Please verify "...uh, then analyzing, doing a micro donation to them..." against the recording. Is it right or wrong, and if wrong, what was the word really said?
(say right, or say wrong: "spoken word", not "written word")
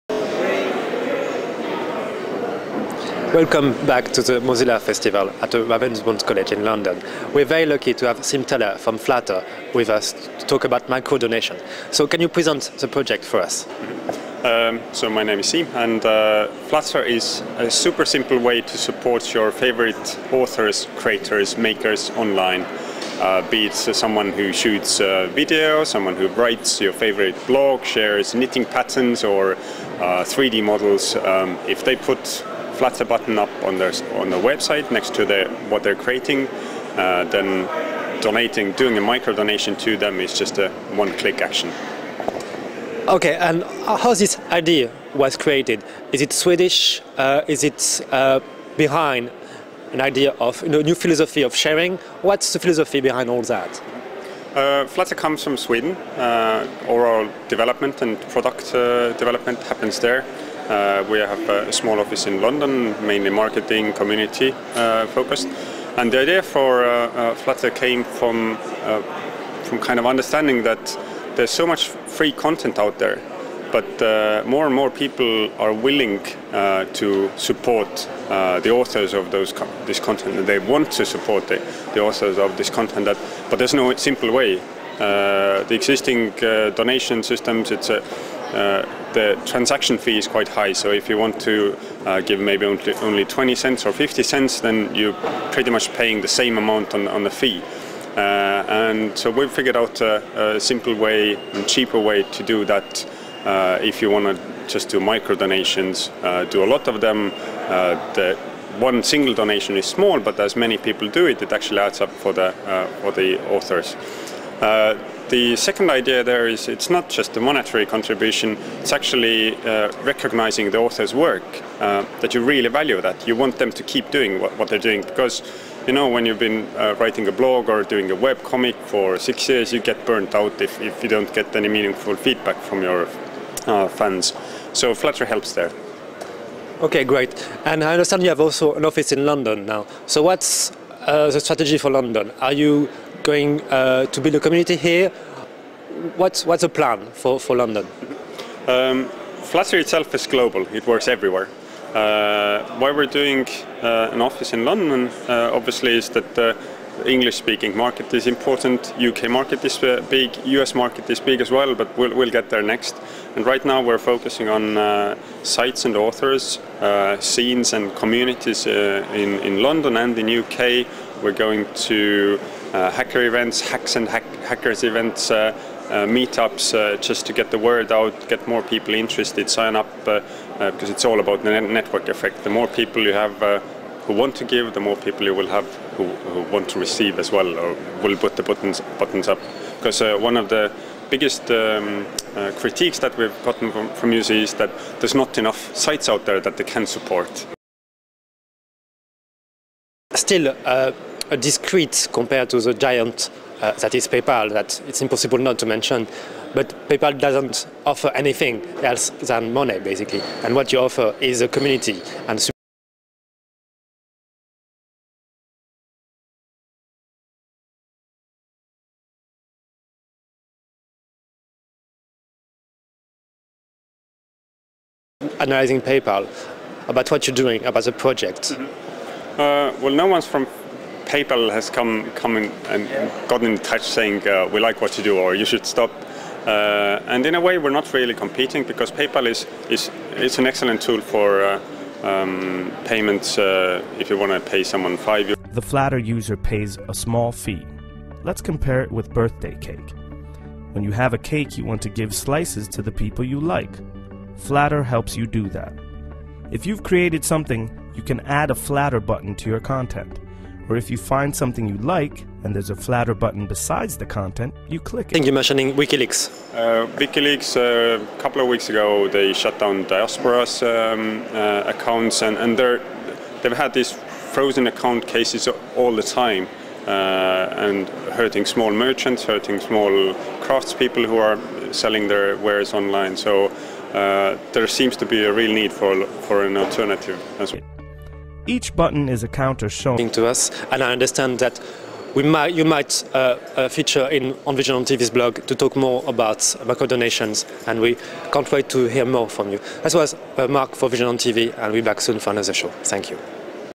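wrong: "donating", not "analyzing".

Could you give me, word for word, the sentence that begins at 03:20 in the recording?
Still uh, discreet compared to the giant uh, that is PayPal, that it's impossible not to mention.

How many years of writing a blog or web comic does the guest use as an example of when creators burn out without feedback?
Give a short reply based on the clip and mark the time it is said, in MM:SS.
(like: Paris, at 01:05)
6, at 02:09.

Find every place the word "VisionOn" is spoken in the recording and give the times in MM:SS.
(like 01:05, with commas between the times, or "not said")
04:54, 05:00.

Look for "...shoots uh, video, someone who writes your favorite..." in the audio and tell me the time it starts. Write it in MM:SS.
00:24.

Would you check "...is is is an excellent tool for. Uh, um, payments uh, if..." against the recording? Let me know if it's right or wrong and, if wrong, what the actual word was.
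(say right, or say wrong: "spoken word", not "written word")
right.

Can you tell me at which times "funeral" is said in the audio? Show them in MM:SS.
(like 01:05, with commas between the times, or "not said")
not said.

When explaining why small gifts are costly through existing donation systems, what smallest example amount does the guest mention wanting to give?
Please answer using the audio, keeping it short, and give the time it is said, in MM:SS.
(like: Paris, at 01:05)
20 cents, at 01:33.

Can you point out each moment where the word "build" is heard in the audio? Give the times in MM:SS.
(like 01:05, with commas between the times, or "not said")
02:24.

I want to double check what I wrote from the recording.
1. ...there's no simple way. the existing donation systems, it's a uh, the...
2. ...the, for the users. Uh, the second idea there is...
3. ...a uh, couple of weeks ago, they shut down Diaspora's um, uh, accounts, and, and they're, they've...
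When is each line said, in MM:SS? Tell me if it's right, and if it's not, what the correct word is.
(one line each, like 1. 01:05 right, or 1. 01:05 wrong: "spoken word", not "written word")
1. 01:23 right
2. 01:52 wrong: "authors", not "users"
3. 04:27 right.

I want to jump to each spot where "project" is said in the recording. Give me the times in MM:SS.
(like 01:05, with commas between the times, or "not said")
00:12, 03:47.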